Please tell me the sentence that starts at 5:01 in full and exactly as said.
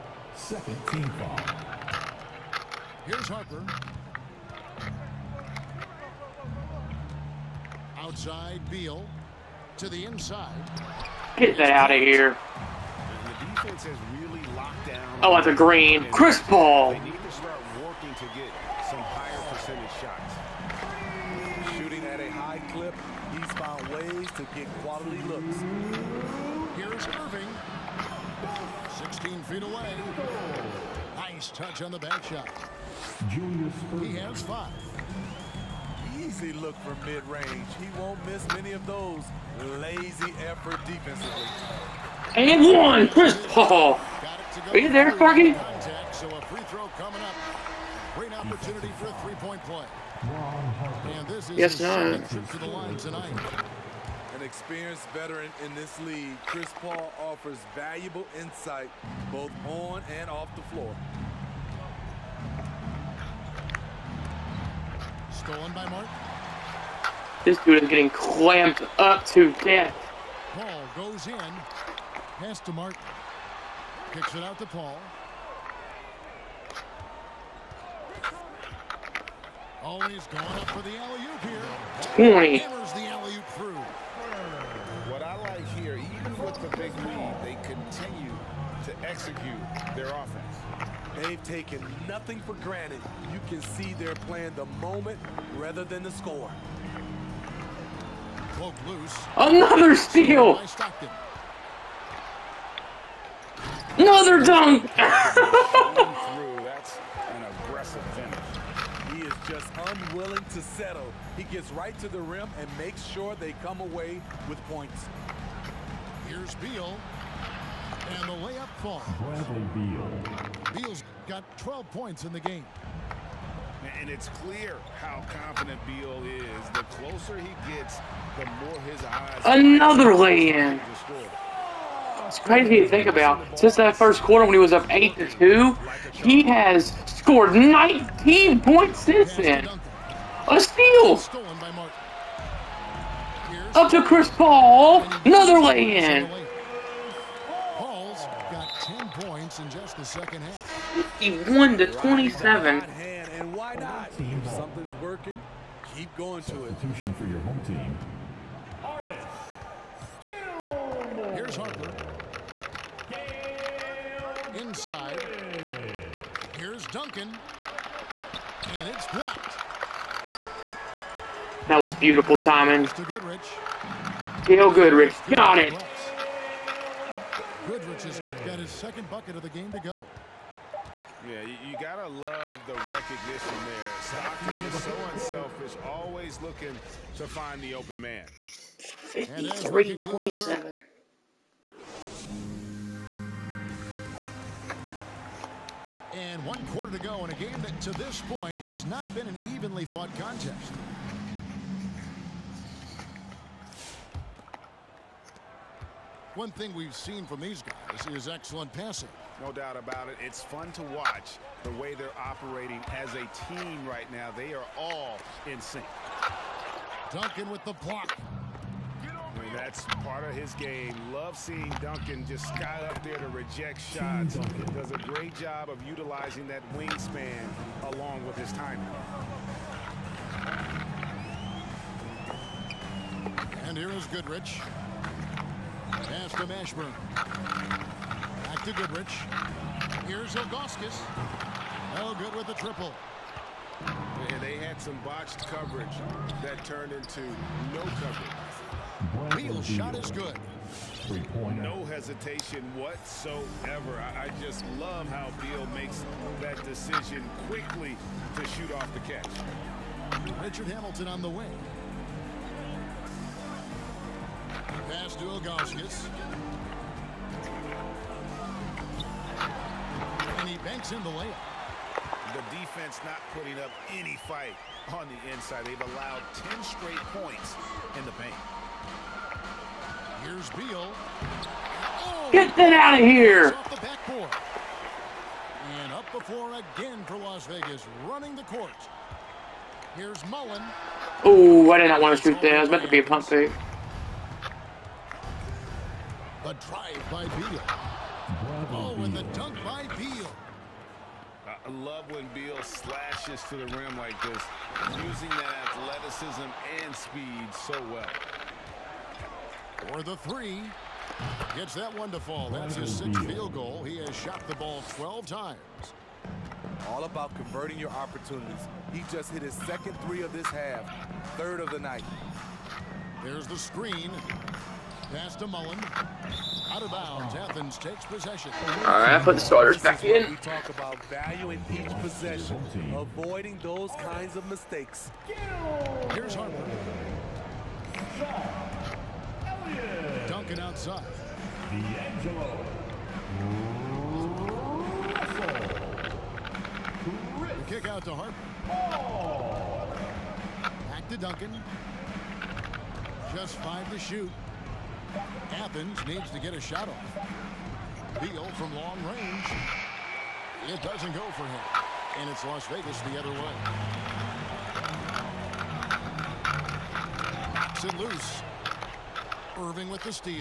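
I love when Beal slashes to the rim like this, using that athleticism and speed so well.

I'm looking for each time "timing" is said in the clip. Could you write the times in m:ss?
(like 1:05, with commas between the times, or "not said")
2:52, 3:48.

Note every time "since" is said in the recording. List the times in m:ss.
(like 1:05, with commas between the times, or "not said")
2:13, 2:18.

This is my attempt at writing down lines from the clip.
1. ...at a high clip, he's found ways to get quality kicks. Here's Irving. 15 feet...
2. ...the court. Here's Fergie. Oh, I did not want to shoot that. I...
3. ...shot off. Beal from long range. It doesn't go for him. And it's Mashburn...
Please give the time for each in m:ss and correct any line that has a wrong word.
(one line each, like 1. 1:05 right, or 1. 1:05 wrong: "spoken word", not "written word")
1. 0:22 wrong: "looks", not "kicks"
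2. 4:48 wrong: "Mullin", not "Fergie"
3. 5:56 wrong: "Las", not "Mashburn".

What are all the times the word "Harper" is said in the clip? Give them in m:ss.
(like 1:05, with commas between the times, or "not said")
0:03, 2:41, 5:36, 5:48.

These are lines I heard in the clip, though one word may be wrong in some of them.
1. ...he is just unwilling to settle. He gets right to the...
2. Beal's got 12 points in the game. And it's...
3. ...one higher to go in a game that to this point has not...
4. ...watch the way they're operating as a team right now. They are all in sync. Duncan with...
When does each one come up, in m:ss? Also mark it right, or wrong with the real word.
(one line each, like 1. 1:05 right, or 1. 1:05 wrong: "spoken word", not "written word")
1. 1:49 right
2. 2:00 right
3. 3:16 wrong: "quarter", not "higher"
4. 3:30 right.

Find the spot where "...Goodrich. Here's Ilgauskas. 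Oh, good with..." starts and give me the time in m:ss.
3:58.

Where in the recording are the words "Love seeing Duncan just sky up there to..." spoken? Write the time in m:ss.
3:41.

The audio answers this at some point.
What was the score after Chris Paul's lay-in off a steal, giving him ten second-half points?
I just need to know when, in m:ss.
2:31.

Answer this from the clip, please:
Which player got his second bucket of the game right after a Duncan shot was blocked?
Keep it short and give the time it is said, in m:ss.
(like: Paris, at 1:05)
Gail Goodrich, at 2:54.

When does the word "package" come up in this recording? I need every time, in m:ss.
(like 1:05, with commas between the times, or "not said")
not said.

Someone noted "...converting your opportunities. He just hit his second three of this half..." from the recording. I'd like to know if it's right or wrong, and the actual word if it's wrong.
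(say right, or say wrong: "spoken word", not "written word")
right.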